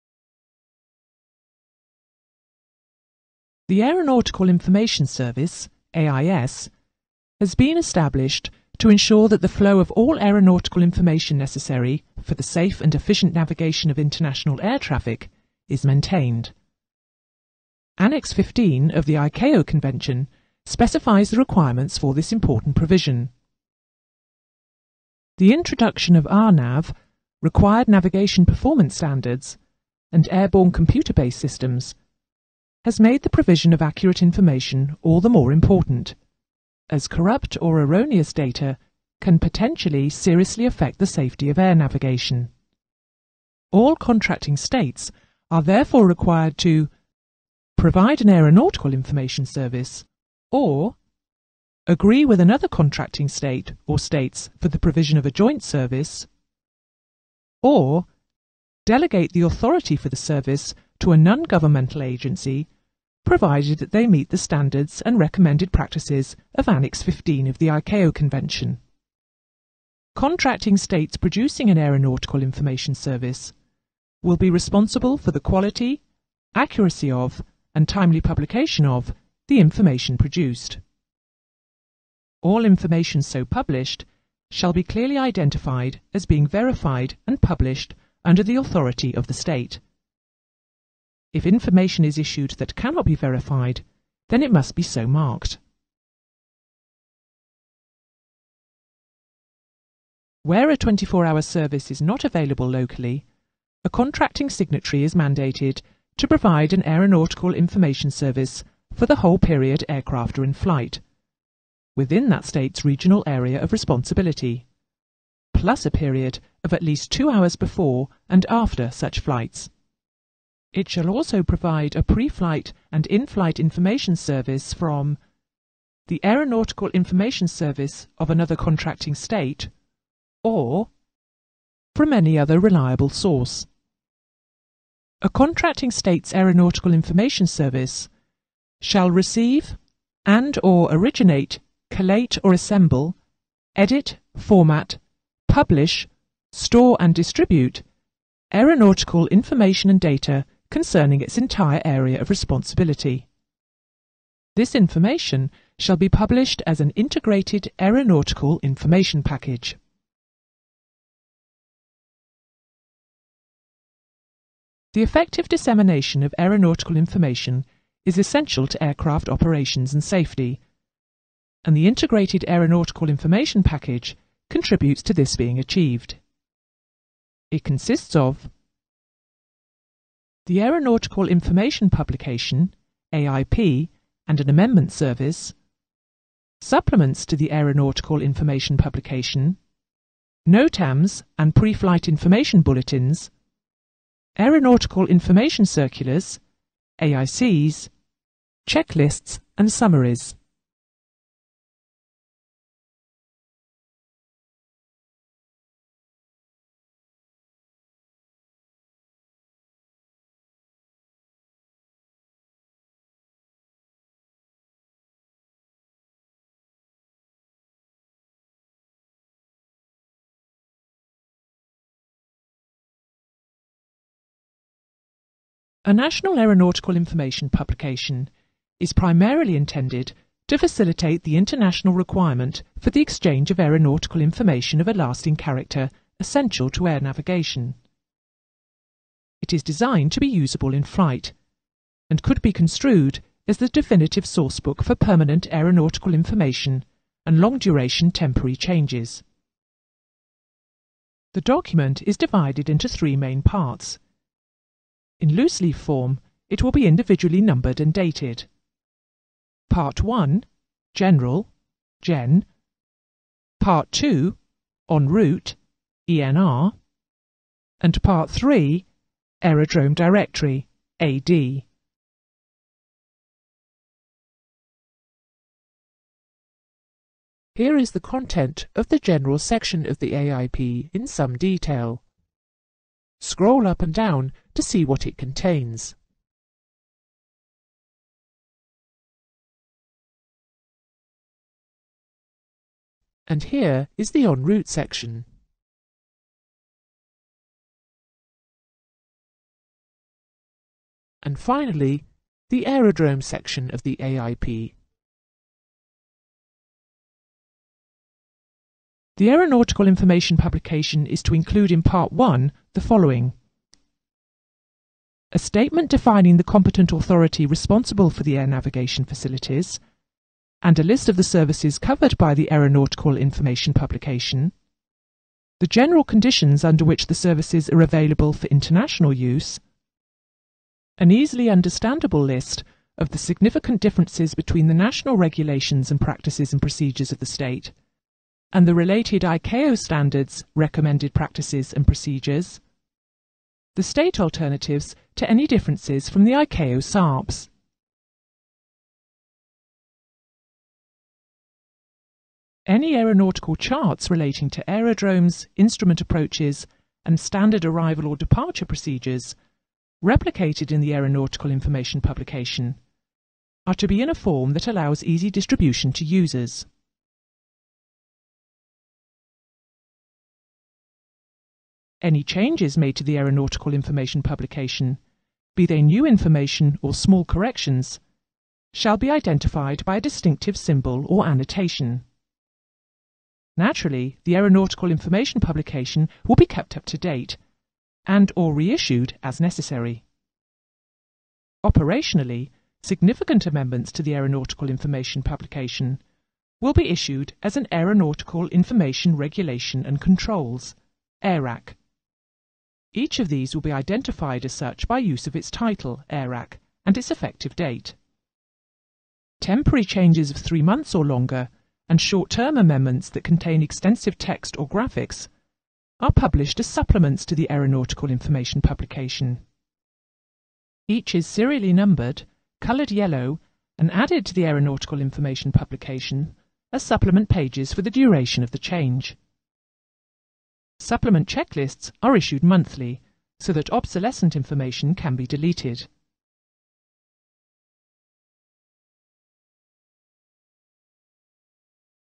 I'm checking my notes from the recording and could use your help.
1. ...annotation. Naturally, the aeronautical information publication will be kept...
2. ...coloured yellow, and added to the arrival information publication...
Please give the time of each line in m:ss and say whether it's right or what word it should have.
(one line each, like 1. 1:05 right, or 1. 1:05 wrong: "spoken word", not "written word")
1. 6:21 right
2. 7:02 wrong: "aeronautical", not "arrival".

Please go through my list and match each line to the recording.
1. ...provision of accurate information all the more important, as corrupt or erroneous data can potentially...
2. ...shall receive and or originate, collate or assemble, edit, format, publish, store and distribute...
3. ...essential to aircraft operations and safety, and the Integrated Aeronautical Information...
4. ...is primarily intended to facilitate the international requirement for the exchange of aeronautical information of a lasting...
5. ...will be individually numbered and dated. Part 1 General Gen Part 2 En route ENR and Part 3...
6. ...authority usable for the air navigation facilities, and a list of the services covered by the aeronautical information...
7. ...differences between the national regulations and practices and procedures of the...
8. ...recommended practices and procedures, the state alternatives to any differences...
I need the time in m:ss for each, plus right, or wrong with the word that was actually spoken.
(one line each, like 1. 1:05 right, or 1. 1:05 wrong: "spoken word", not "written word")
1. 0:33 right
2. 2:18 right
3. 2:48 right
4. 3:48 right
5. 4:16 right
6. 5:16 wrong: "responsible", not "usable"
7. 5:33 right
8. 5:40 right.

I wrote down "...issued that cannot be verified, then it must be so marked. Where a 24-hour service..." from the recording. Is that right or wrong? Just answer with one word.
right.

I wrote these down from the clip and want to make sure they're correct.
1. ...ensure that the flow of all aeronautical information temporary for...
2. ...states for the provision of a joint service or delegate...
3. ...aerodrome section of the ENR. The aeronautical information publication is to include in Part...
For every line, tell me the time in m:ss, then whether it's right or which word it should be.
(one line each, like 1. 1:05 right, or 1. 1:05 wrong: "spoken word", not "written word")
1. 0:08 wrong: "necessary", not "temporary"
2. 0:53 right
3. 5:02 wrong: "AIP", not "ENR".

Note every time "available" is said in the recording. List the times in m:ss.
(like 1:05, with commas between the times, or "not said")
1:42, 5:27.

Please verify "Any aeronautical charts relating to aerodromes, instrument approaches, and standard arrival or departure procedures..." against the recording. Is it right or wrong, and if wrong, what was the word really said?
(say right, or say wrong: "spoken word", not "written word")
right.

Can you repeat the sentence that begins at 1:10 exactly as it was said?
Contracting states producing an aeronautical information service will be responsible for the quality, accuracy of, and timely publication of the information produced.